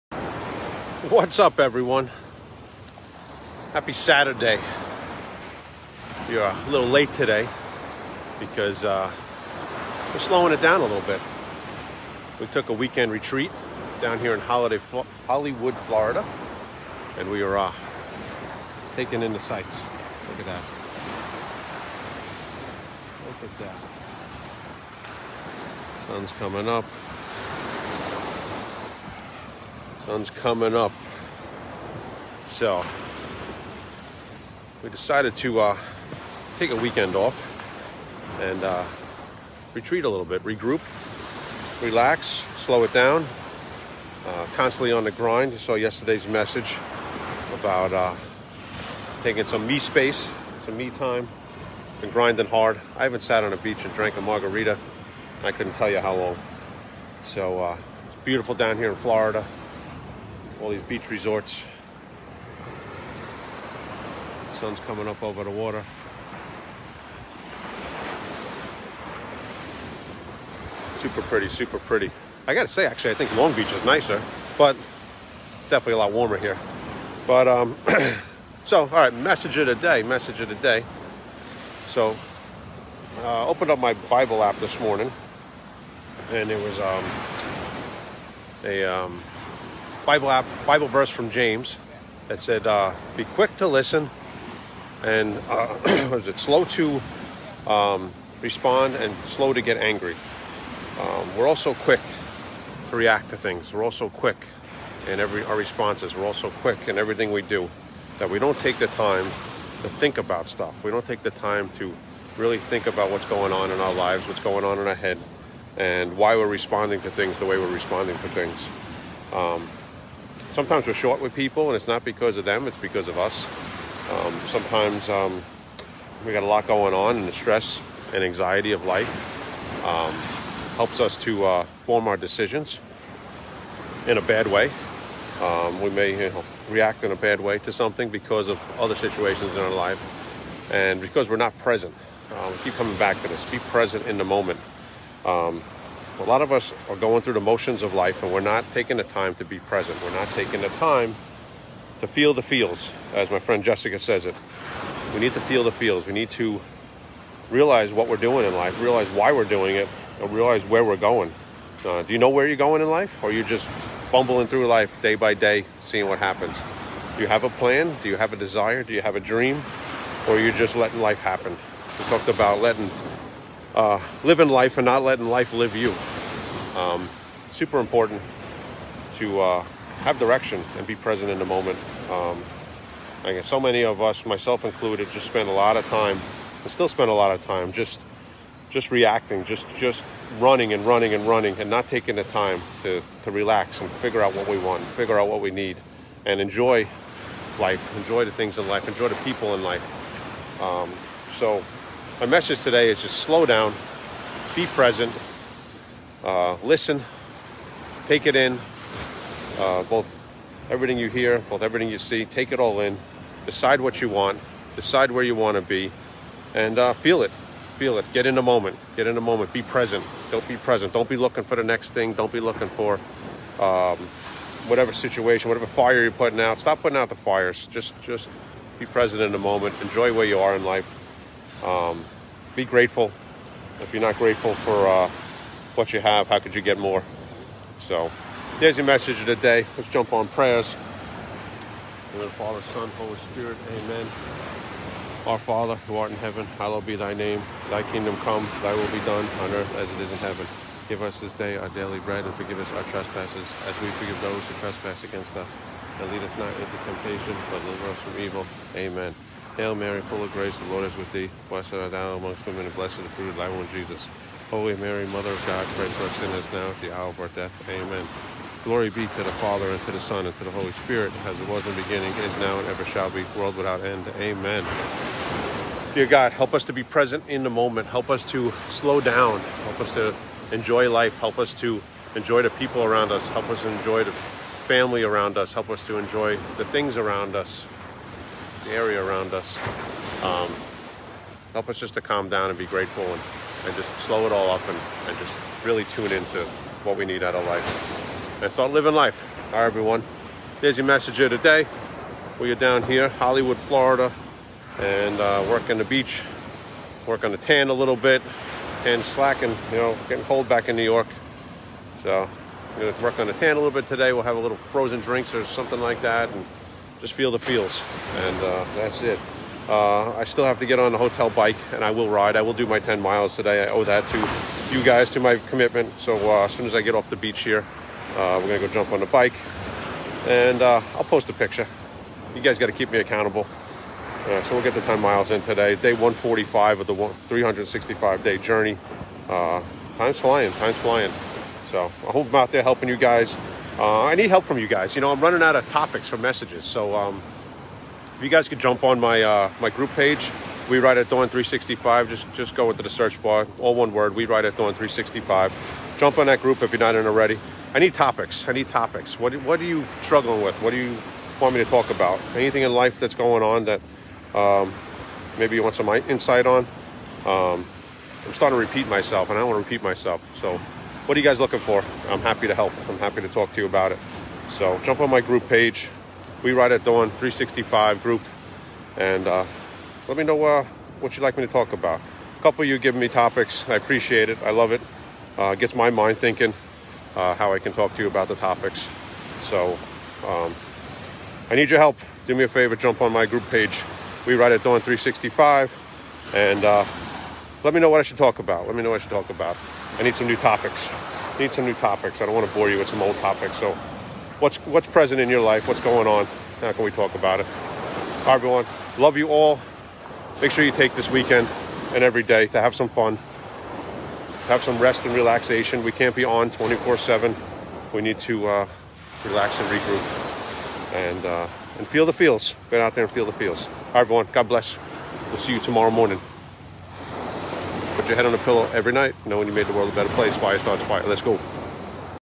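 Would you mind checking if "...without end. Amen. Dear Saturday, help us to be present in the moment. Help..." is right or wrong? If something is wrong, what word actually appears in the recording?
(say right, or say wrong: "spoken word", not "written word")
wrong: "God", not "Saturday".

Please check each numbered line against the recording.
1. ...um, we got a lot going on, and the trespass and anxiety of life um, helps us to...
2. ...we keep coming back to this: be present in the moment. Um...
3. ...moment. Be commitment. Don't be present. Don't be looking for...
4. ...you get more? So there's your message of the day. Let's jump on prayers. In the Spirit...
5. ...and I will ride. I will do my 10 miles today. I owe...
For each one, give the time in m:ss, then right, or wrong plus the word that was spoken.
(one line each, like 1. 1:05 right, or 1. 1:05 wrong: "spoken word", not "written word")
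1. 2:05 wrong: "stress", not "trespass"
2. 2:22 right
3. 3:39 wrong: "present", not "commitment"
4. 3:56 wrong: "Father", not "Spirit"
5. 5:21 right.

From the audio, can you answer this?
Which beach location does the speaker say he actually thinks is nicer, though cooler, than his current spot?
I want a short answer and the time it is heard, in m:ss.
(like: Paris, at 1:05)
Long Beach, at 1:13.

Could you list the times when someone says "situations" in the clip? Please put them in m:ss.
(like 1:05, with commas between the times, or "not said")
2:18, 3:44.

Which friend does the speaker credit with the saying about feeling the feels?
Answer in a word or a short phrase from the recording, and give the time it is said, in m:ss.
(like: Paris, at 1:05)
Jessica, at 2:33.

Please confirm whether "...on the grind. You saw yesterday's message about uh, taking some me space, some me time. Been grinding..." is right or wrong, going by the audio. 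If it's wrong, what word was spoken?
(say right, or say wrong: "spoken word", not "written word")
right.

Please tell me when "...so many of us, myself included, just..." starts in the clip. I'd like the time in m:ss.
3:03.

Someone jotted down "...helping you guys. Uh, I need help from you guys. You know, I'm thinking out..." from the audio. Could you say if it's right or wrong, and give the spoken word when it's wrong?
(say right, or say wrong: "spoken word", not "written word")
wrong: "running", not "thinking".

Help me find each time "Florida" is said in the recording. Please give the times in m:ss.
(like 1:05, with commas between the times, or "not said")
0:15, 0:58, 5:03.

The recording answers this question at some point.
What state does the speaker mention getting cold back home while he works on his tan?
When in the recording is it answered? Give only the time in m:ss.
5:10.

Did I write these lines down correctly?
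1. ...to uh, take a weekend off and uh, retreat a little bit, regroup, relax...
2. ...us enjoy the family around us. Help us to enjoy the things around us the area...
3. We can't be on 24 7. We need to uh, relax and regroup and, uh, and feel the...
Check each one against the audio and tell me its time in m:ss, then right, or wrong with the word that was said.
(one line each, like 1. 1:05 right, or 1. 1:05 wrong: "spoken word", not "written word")
1. 0:35 right
2. 4:43 right
3. 6:55 right.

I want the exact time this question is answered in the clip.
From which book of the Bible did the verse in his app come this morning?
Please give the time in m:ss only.
1:31.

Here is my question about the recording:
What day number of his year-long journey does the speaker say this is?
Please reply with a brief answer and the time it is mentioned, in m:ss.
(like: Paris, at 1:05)
145, at 5:35.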